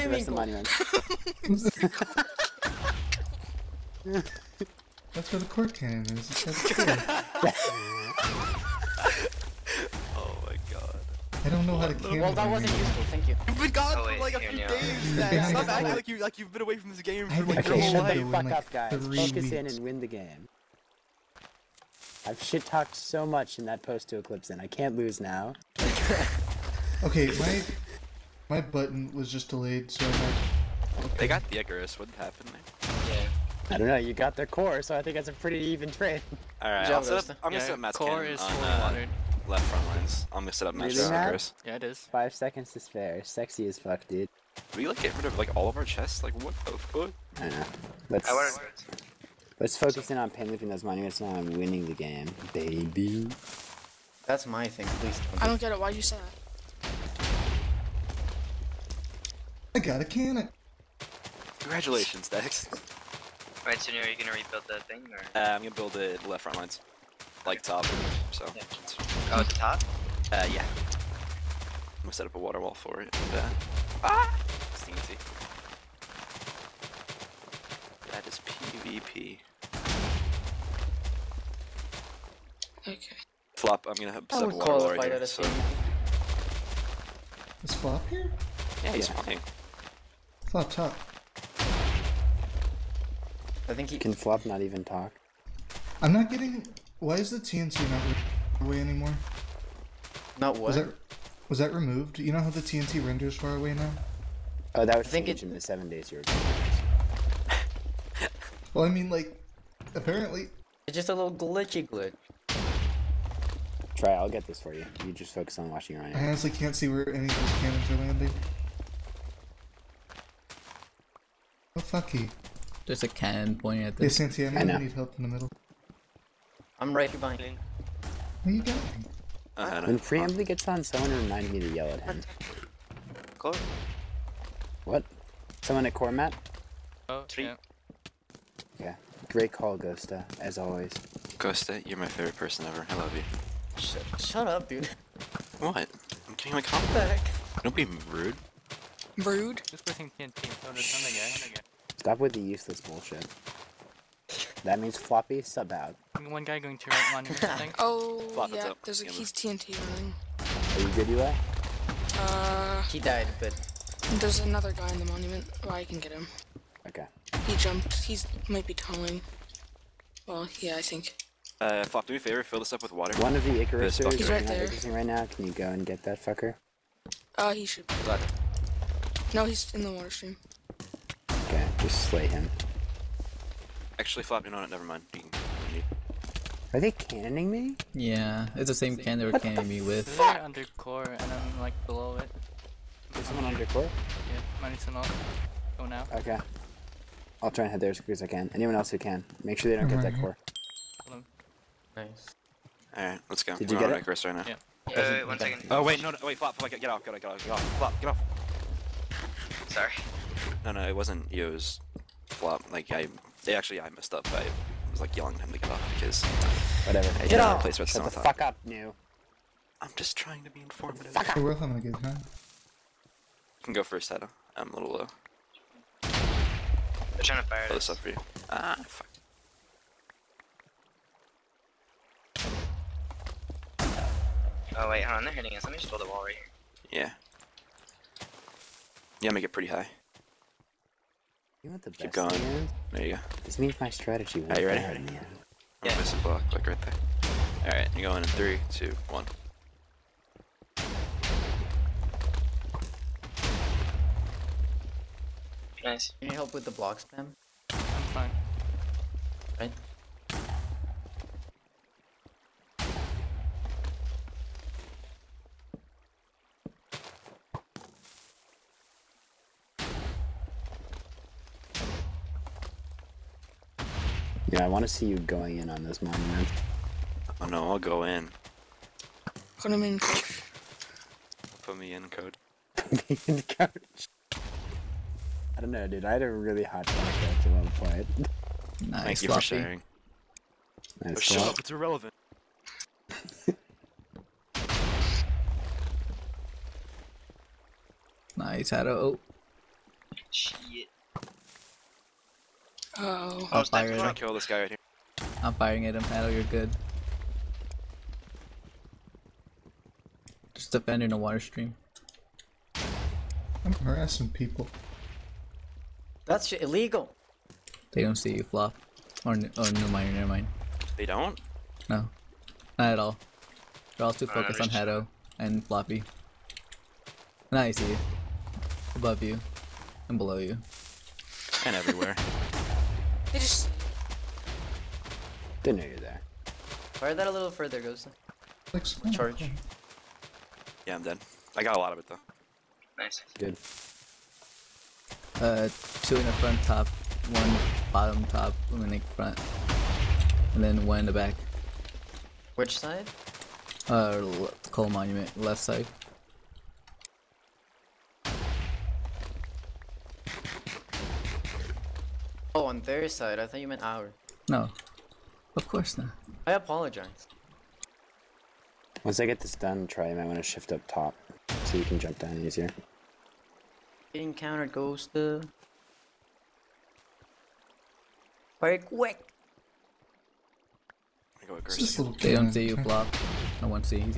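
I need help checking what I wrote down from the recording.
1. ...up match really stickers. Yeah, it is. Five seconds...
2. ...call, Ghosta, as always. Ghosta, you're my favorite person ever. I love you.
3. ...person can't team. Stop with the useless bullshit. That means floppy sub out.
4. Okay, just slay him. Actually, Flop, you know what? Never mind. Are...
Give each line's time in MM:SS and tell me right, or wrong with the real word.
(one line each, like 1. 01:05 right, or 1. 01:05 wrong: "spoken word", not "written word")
1. 00:40 right
2. 02:19 right
3. 02:29 right
4. 03:01 right.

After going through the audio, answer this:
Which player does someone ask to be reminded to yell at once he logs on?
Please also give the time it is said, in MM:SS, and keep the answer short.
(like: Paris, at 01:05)
Preemptively, at 02:09.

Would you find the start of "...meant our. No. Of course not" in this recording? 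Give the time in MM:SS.
06:03.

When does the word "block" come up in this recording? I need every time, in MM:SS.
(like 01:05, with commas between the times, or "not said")
04:06, 04:16, 06:22.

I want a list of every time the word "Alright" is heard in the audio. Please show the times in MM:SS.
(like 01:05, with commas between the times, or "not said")
00:36, 01:03, 03:22.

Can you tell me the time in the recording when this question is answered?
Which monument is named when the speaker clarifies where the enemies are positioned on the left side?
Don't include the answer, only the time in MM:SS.
05:54.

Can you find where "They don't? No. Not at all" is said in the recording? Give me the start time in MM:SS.
05:20.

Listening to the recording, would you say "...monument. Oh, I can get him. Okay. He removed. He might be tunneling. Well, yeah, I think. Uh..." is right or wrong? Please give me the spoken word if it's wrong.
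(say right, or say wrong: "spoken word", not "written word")
wrong: "jumped", not "removed".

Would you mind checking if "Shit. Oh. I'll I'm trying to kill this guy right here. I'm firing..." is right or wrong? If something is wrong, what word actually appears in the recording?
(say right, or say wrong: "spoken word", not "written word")
right.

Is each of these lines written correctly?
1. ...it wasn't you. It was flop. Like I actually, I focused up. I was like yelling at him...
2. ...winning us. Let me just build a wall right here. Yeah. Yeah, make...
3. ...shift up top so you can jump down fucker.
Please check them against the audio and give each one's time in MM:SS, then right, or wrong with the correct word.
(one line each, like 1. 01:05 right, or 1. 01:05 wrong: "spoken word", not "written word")
1. 03:30 wrong: "messed", not "focused"
2. 03:55 wrong: "hitting", not "winning"
3. 06:10 wrong: "easier", not "fucker".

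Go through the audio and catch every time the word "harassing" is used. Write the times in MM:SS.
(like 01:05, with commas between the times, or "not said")
05:13.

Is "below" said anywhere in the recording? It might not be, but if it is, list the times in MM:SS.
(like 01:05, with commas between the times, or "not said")
03:11, 05:30.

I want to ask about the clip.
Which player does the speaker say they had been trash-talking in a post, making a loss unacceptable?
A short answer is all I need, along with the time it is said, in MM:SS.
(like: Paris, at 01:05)
Eclipse, at 00:24.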